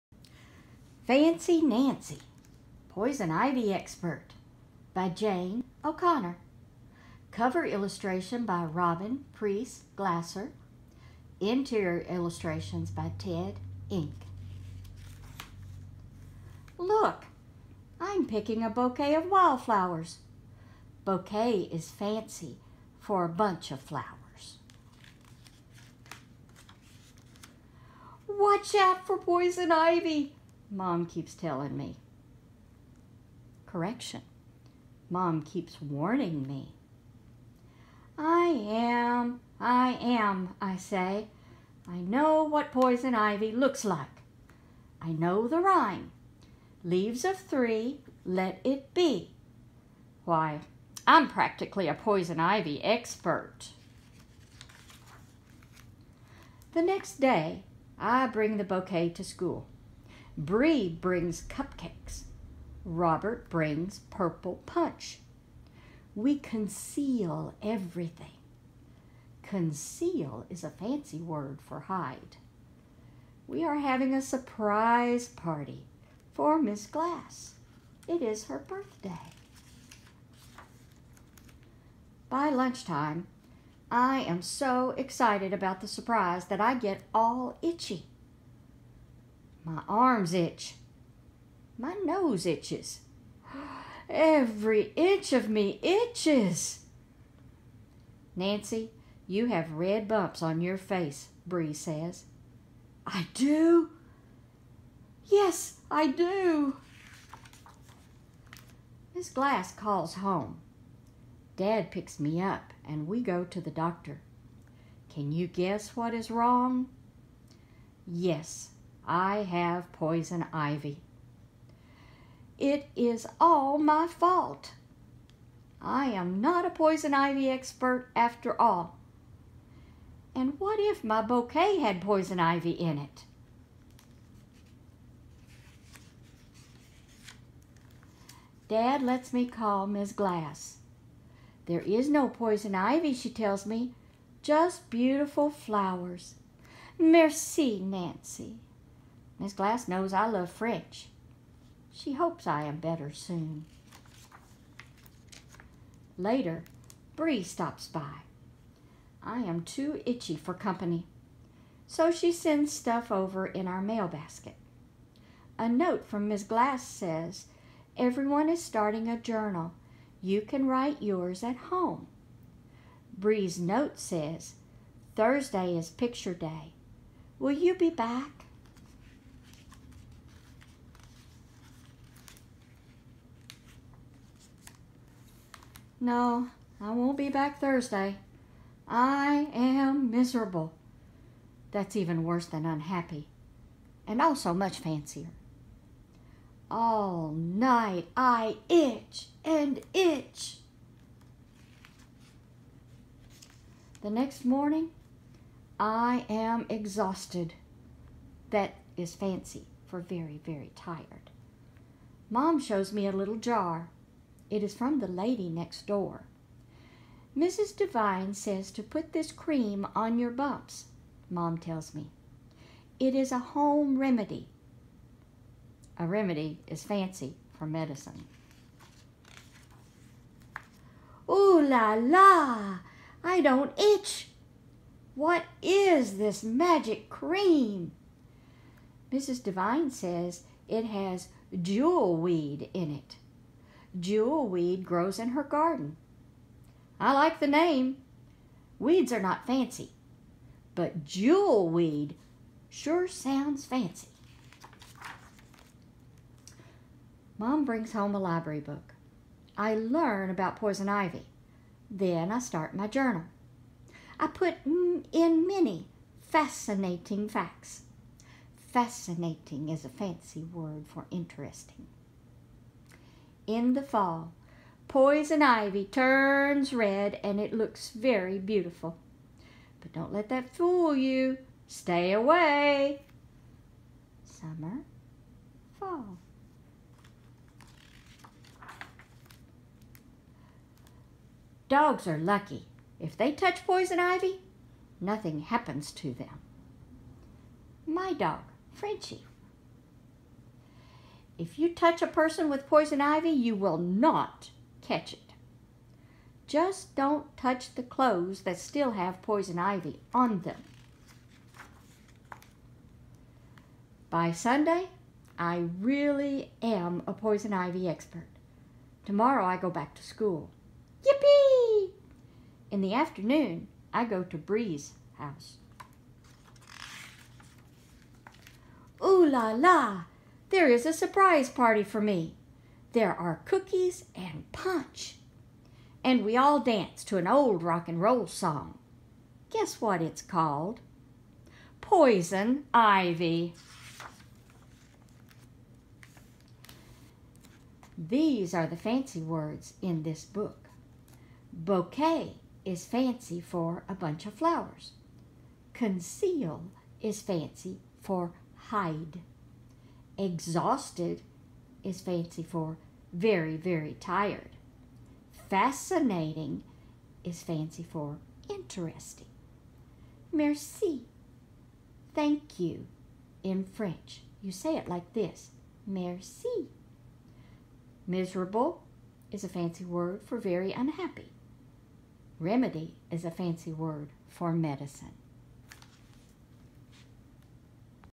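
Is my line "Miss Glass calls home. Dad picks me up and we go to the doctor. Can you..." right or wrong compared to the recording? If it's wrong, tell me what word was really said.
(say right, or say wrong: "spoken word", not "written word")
right.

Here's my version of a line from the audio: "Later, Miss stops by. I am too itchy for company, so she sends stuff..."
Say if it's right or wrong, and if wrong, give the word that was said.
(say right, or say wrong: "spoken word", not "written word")
wrong: "Bree", not "Miss".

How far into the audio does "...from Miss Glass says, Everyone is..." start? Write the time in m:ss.
2:46.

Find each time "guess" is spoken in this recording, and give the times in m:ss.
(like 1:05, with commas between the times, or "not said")
1:55, 5:39.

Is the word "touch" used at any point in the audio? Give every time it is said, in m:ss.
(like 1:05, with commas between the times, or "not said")
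4:53, 5:01, 5:07.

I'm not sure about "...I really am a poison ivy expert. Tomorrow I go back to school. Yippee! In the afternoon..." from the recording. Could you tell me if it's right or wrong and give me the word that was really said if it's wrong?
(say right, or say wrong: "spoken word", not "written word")
right.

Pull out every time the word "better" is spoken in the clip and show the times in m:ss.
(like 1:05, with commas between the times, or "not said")
2:32.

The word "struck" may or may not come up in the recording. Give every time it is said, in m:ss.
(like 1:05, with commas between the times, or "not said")
not said.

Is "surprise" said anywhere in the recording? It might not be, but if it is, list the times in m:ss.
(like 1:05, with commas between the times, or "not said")
1:14, 1:25, 5:30.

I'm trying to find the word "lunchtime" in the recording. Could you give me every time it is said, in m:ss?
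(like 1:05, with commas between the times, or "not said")
1:22.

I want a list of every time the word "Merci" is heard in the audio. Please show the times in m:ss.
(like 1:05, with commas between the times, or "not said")
2:26, 6:10, 6:15.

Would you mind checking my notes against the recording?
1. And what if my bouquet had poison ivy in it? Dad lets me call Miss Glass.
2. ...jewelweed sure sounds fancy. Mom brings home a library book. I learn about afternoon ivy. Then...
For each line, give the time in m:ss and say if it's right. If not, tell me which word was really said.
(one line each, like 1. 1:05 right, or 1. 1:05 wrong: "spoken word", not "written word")
1. 2:10 right
2. 4:11 wrong: "poison", not "afternoon".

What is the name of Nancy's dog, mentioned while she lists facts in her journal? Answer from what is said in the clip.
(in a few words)
Frenchie.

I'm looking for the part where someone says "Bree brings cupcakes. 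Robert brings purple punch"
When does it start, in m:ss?
1:00.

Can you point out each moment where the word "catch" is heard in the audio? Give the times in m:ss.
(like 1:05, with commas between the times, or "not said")
5:04.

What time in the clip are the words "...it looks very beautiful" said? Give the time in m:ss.
4:37.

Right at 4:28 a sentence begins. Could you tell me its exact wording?
Fascinating is a fancy word for interesting in the fall.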